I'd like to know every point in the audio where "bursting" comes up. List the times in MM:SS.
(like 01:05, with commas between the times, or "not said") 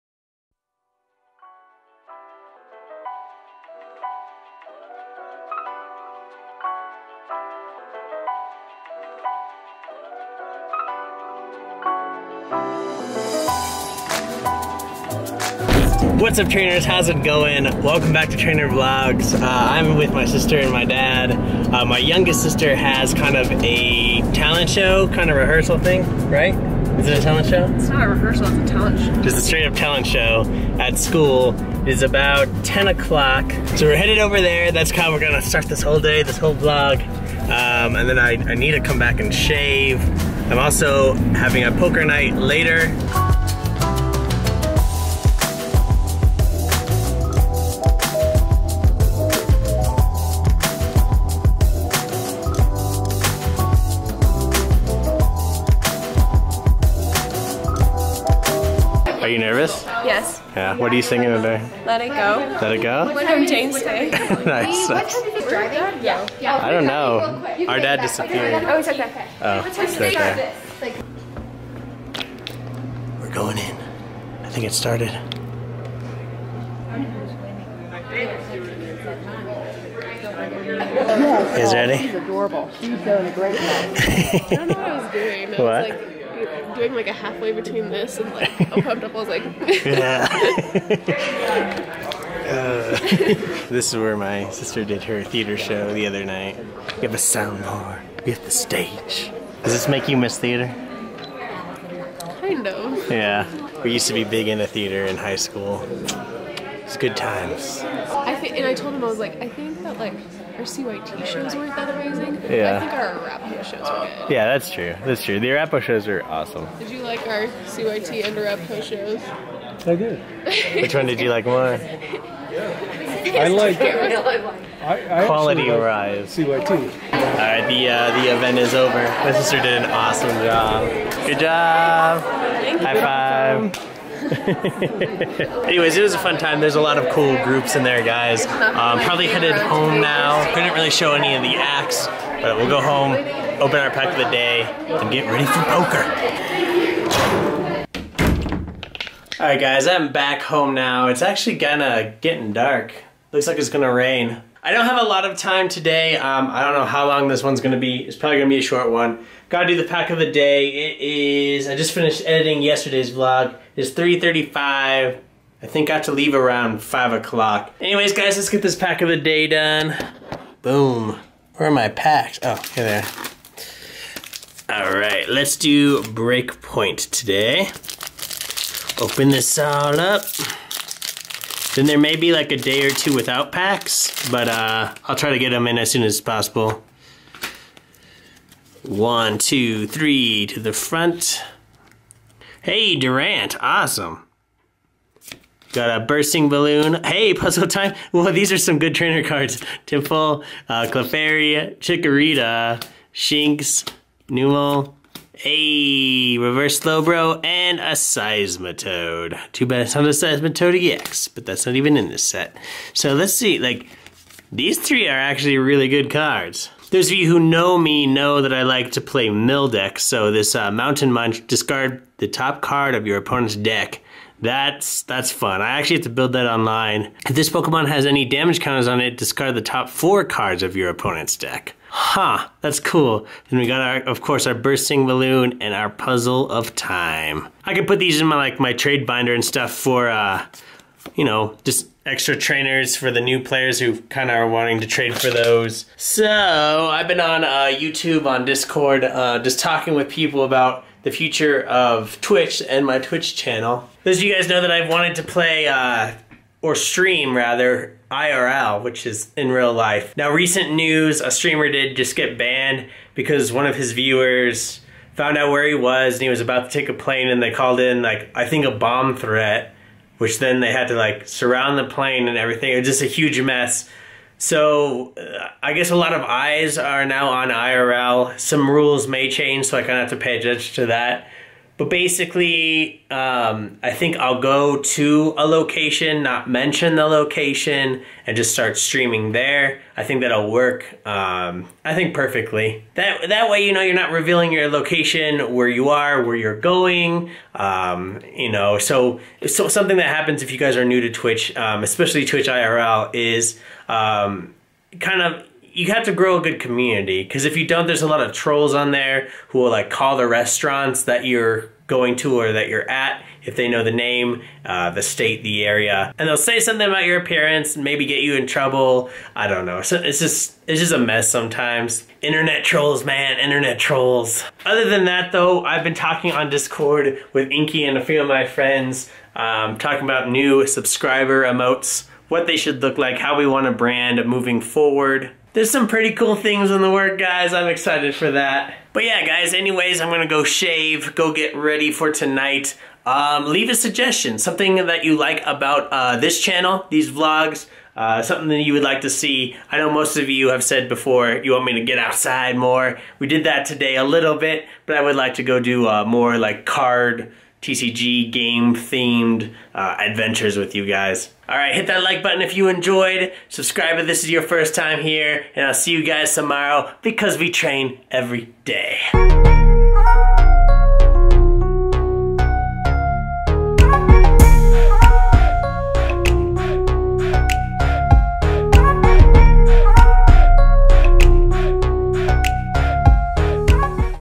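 03:16, 03:54.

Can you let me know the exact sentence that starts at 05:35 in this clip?
There's some pretty cool things in the work, guys.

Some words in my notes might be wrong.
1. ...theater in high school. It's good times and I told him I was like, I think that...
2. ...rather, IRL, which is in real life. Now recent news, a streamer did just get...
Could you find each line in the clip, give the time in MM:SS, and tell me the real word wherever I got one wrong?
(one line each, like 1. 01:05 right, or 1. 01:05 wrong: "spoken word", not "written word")
1. 01:44 right
2. 04:17 right.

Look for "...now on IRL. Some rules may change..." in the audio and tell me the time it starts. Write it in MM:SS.
04:37.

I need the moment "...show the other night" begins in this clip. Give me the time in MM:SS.
01:35.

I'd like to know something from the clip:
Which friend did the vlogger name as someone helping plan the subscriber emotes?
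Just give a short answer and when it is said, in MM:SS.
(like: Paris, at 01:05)
Inky, at 05:27.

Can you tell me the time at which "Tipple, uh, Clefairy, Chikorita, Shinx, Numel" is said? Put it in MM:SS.
03:19.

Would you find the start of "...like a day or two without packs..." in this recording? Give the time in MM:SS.
03:02.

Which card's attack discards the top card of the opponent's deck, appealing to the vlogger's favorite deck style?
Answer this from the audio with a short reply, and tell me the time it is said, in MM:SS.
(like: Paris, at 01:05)
Mountain Munch, at 03:40.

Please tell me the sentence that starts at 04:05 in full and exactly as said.
So I've been on uh, YouTube, on Discord, uh, just talking with people about the future of Twitch and my Twitch channel.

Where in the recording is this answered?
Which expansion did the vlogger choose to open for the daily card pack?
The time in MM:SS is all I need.
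02:56.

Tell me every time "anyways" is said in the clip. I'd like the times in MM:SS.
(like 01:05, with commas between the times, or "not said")
02:14, 02:47, 05:39.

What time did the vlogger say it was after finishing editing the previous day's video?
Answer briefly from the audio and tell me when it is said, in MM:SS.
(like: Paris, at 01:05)
3:35, at 02:43.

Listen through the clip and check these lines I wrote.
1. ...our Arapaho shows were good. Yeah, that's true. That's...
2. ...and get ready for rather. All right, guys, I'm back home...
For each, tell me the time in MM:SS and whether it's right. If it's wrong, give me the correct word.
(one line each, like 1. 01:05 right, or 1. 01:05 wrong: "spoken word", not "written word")
1. 01:52 right
2. 02:24 wrong: "poker", not "rather".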